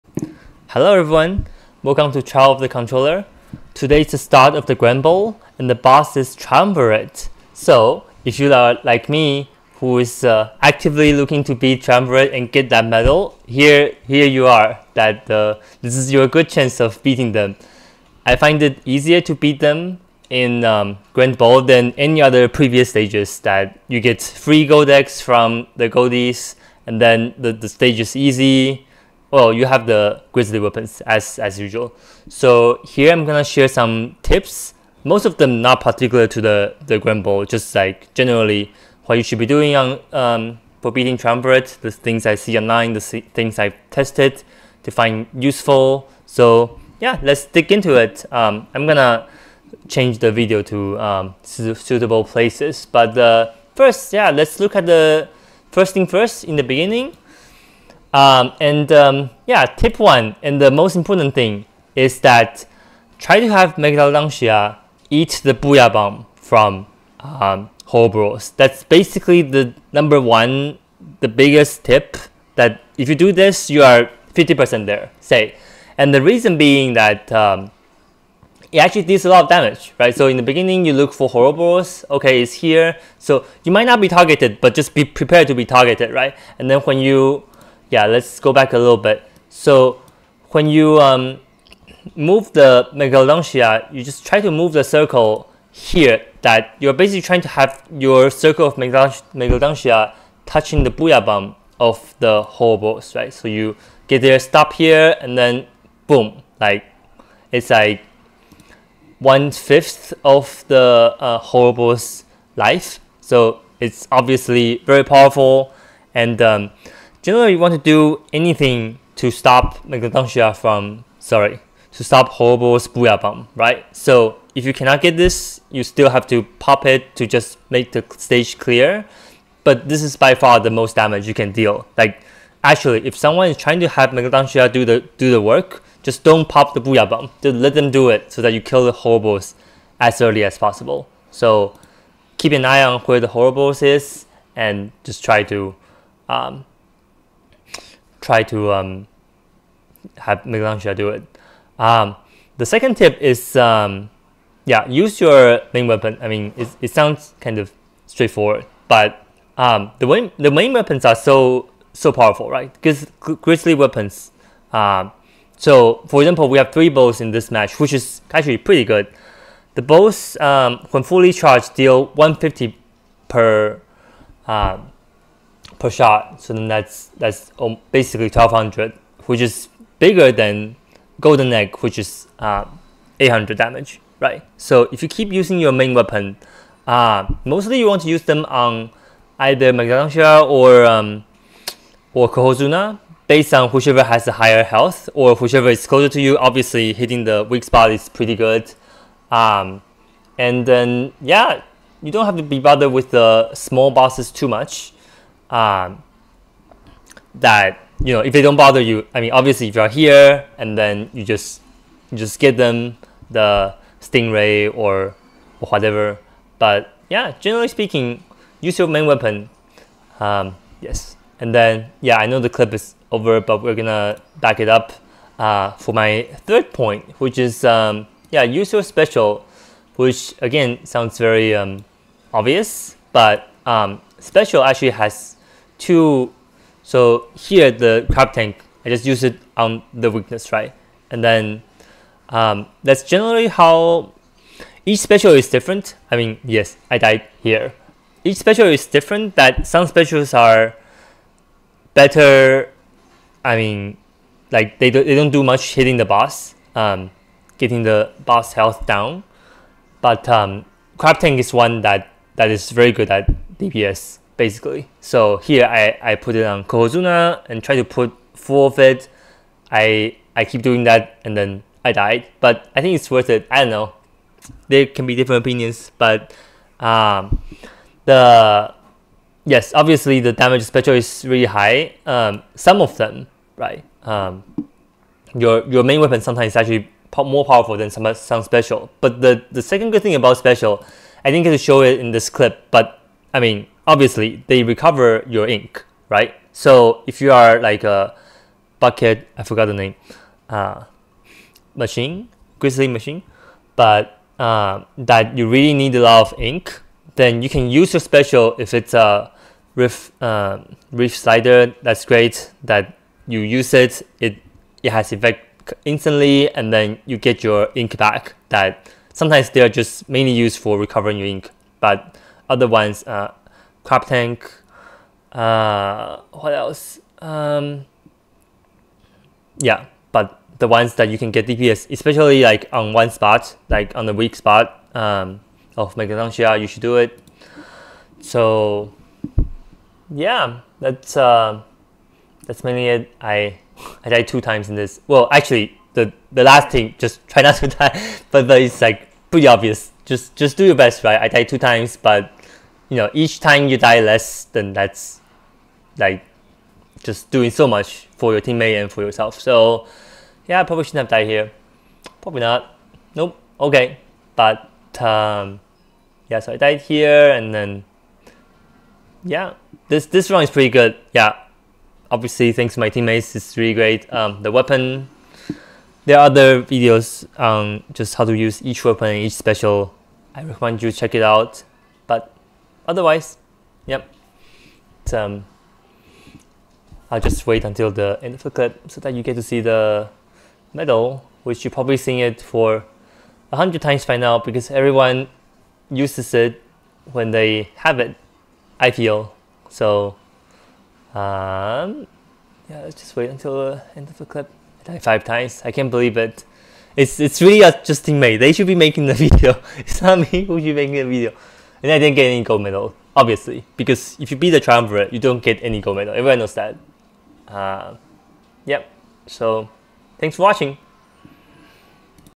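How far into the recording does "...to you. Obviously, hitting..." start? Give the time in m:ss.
3:16.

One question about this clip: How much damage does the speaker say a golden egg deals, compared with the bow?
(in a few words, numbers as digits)
800.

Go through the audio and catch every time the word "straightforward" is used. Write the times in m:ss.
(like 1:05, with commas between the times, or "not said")
2:38.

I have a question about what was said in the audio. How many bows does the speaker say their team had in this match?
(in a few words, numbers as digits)
3.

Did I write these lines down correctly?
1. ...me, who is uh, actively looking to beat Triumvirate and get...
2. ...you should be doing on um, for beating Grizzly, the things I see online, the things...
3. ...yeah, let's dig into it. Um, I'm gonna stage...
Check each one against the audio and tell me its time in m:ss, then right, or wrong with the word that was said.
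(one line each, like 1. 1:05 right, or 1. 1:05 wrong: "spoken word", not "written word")
1. 0:09 right
2. 0:39 wrong: "Triumvirate", not "Grizzly"
3. 0:46 wrong: "change", not "stage".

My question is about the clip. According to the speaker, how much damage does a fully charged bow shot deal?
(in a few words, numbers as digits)
150.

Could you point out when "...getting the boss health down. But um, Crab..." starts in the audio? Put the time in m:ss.
4:17.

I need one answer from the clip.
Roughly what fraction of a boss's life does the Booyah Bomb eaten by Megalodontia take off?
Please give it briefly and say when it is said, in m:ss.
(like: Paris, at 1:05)
one fifth, at 1:49.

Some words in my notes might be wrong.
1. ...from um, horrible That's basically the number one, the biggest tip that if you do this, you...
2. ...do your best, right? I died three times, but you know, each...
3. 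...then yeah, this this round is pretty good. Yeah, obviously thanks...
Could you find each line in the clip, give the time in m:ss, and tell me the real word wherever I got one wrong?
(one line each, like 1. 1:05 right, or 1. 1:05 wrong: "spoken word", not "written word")
1. 1:06 wrong: "whole", not "horrible"
2. 5:50 wrong: "two", not "three"
3. 6:07 right.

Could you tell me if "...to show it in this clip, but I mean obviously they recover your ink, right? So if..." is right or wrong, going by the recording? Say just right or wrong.
right.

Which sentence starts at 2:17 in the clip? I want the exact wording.
Just let them do it so that you kill the Horroboros as early as possible.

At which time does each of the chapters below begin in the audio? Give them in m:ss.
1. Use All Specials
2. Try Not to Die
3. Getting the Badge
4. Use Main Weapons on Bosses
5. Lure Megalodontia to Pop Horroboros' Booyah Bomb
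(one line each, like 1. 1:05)
1. 3:45
2. 5:41
3. 6:24
4. 2:28
5. 0:58.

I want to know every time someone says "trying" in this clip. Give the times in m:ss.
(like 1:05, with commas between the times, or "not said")
1:37, 2:13.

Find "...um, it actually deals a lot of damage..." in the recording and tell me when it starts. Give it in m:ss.
1:17.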